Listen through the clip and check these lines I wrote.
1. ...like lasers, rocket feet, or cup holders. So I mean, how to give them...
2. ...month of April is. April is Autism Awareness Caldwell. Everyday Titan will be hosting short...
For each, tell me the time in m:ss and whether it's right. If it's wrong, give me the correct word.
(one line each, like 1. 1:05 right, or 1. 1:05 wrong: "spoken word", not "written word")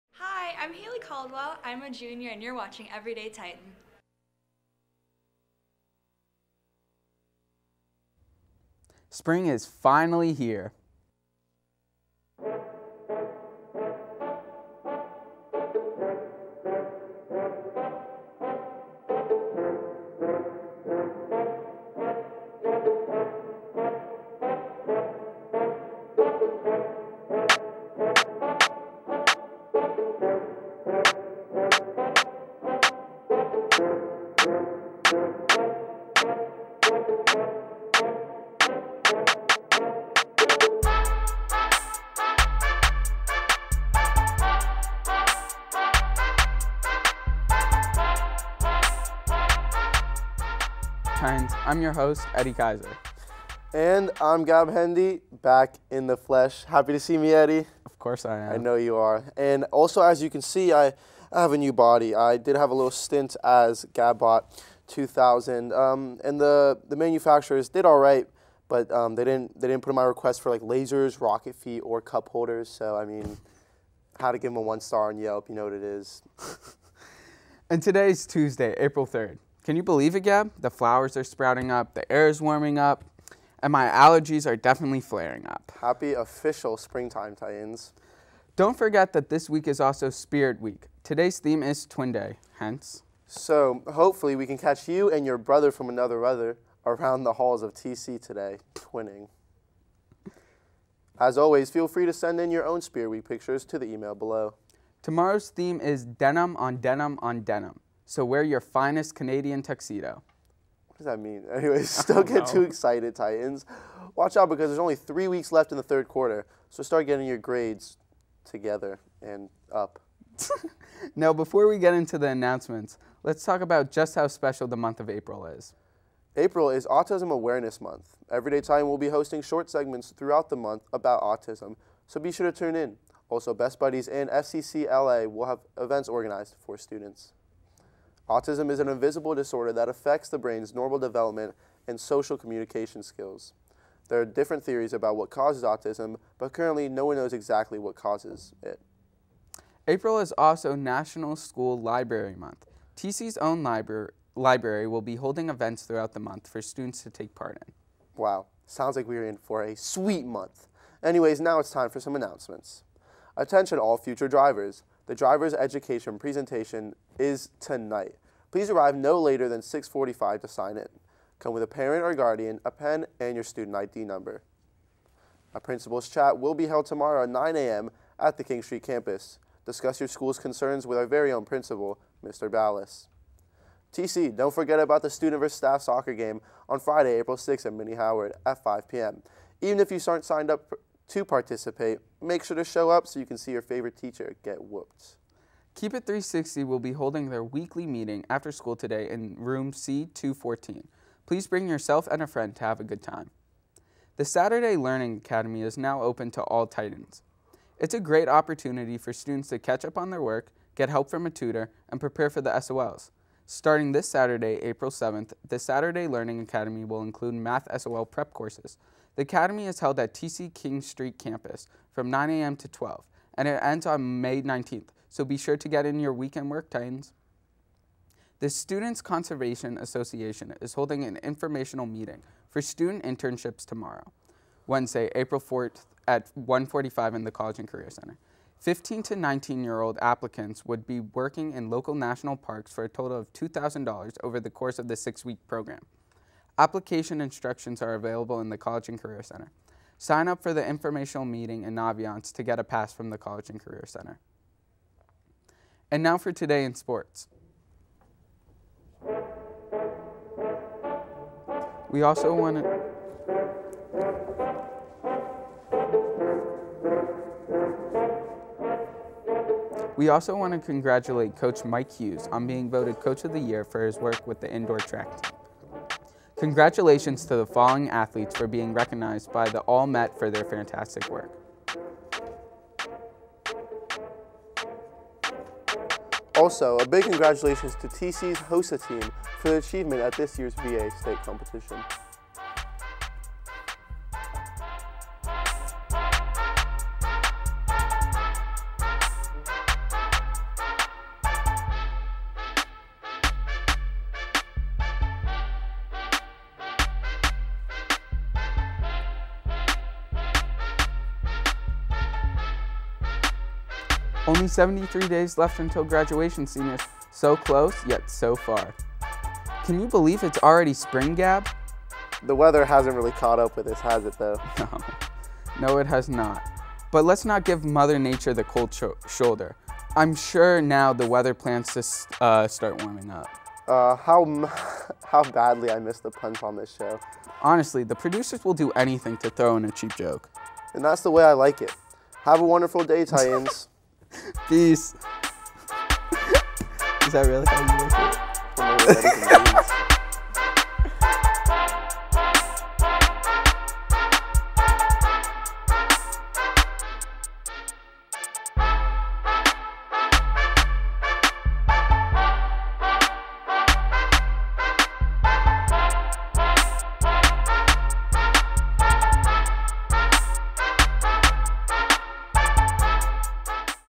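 1. 1:10 right
2. 2:04 wrong: "Month", not "Caldwell".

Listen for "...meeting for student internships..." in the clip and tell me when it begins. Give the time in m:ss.
3:51.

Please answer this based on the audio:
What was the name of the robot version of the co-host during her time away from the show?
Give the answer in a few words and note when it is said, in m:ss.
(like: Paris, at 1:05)
Gabbot 2000, at 1:03.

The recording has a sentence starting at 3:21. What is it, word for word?
Please bring yourself and a friend to have a good time.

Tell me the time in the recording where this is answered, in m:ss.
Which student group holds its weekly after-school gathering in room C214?
3:15.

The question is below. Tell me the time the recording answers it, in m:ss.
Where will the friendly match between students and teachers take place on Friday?
3:07.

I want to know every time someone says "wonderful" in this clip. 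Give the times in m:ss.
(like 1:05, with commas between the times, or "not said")
5:42.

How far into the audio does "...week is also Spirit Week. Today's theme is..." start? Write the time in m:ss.
1:29.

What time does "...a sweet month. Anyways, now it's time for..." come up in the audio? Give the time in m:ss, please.
2:39.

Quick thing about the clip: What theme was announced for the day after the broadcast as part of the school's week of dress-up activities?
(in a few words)
Denim on Denim on Denim.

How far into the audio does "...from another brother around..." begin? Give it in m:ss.
1:35.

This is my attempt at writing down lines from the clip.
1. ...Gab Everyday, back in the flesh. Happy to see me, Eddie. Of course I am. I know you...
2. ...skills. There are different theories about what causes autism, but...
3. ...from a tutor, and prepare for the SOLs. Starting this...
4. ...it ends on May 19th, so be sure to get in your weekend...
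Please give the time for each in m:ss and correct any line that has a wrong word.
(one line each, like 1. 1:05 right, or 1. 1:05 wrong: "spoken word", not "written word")
1. 0:54 wrong: "Hendy", not "Everyday"
2. 2:23 right
3. 3:31 right
4. 3:43 right.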